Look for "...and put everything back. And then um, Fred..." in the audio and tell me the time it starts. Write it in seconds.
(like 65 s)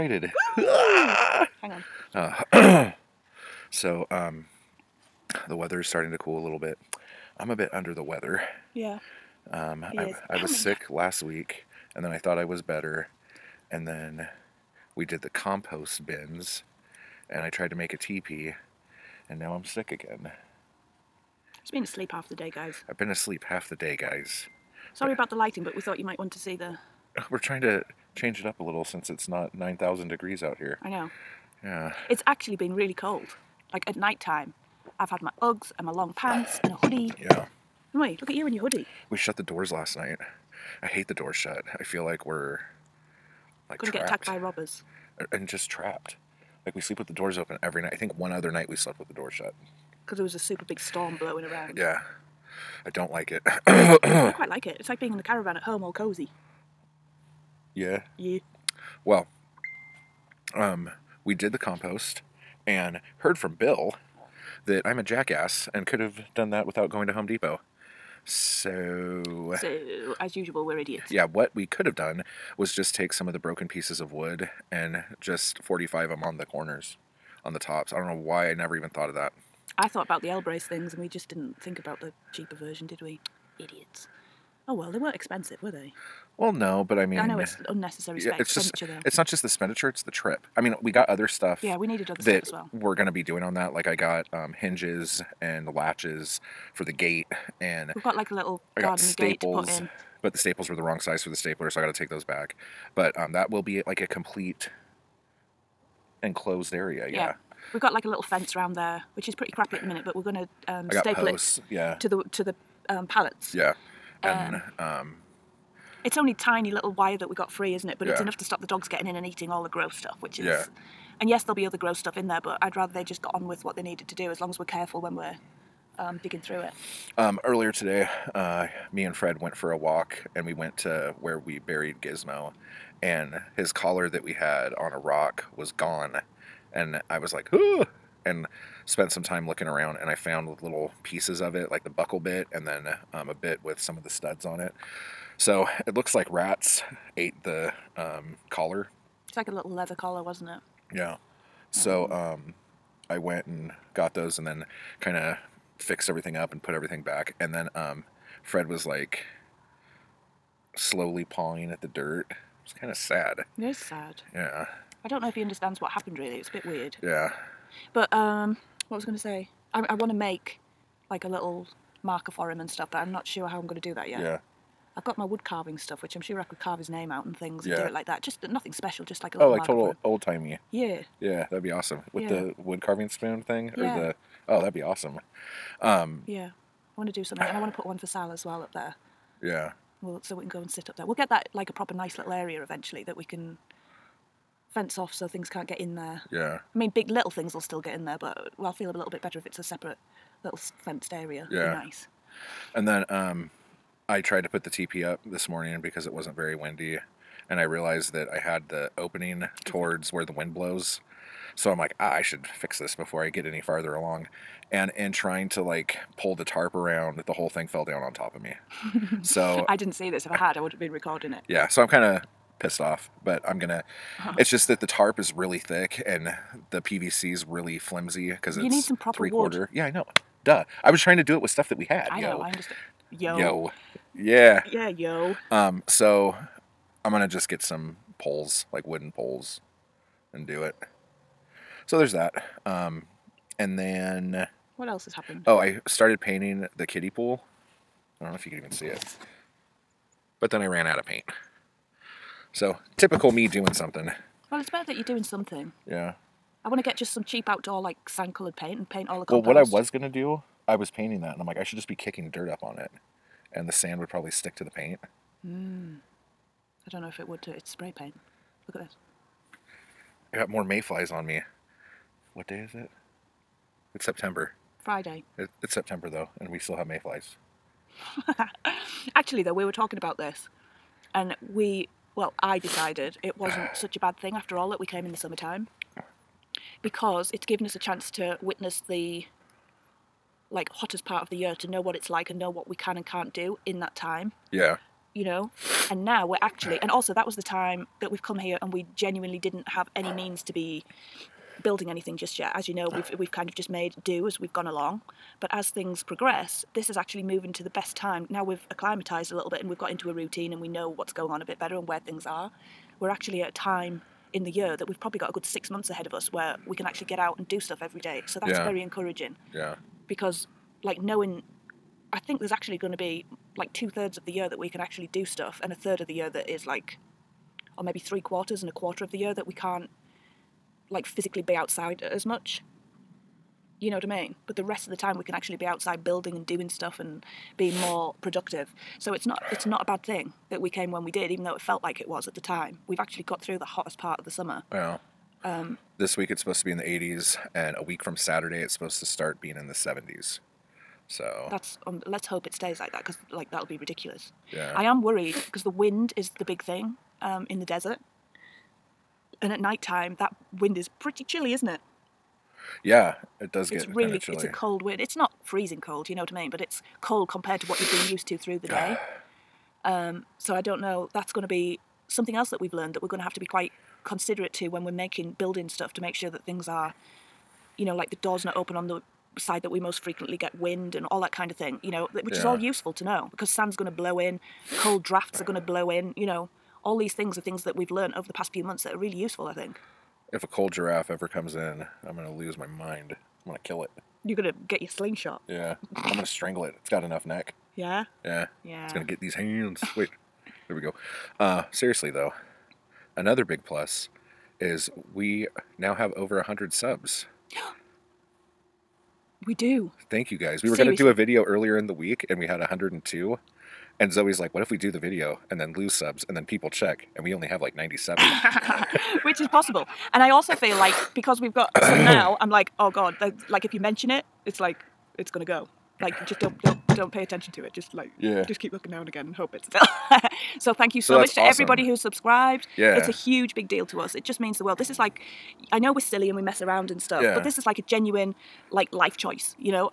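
156 s.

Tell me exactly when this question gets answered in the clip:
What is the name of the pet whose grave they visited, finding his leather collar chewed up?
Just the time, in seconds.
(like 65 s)
132 s.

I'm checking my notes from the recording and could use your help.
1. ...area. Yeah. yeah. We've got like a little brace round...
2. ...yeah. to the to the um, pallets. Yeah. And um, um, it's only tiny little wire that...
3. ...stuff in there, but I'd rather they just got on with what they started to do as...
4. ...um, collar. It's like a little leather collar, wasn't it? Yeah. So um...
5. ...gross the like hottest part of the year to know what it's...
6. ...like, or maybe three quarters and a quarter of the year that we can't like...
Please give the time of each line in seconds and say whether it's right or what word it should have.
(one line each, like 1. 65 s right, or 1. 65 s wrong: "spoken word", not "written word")
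1. 106 s wrong: "fence", not "brace"
2. 111 s right
3. 121 s wrong: "needed", not "started"
4. 147 s right
5. 288 s wrong: "witness", not "gross"
6. 326 s right.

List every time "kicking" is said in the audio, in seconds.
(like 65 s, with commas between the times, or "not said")
261 s.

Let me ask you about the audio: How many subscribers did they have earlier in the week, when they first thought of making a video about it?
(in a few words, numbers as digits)
102.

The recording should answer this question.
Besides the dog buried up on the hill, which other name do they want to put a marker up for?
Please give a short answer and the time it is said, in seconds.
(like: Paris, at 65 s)
Sal, at 188 s.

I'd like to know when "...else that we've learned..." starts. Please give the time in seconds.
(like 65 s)
372 s.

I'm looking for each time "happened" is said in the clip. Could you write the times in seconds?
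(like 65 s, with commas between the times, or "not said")
165 s, 245 s.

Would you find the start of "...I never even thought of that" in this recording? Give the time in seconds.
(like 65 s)
78 s.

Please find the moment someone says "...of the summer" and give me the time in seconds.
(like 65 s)
344 s.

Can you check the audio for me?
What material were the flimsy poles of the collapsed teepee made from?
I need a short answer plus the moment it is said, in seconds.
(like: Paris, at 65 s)
PVC, at 226 s.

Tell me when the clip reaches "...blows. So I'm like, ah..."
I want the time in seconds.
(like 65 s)
210 s.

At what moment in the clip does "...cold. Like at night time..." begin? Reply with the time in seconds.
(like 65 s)
32 s.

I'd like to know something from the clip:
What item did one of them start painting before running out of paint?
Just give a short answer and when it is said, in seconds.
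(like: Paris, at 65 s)
kiddie pool, at 246 s.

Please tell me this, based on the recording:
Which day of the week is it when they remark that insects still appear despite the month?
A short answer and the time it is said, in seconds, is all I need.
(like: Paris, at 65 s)
Friday, at 274 s.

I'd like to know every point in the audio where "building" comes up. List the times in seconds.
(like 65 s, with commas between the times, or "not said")
301 s, 336 s, 375 s.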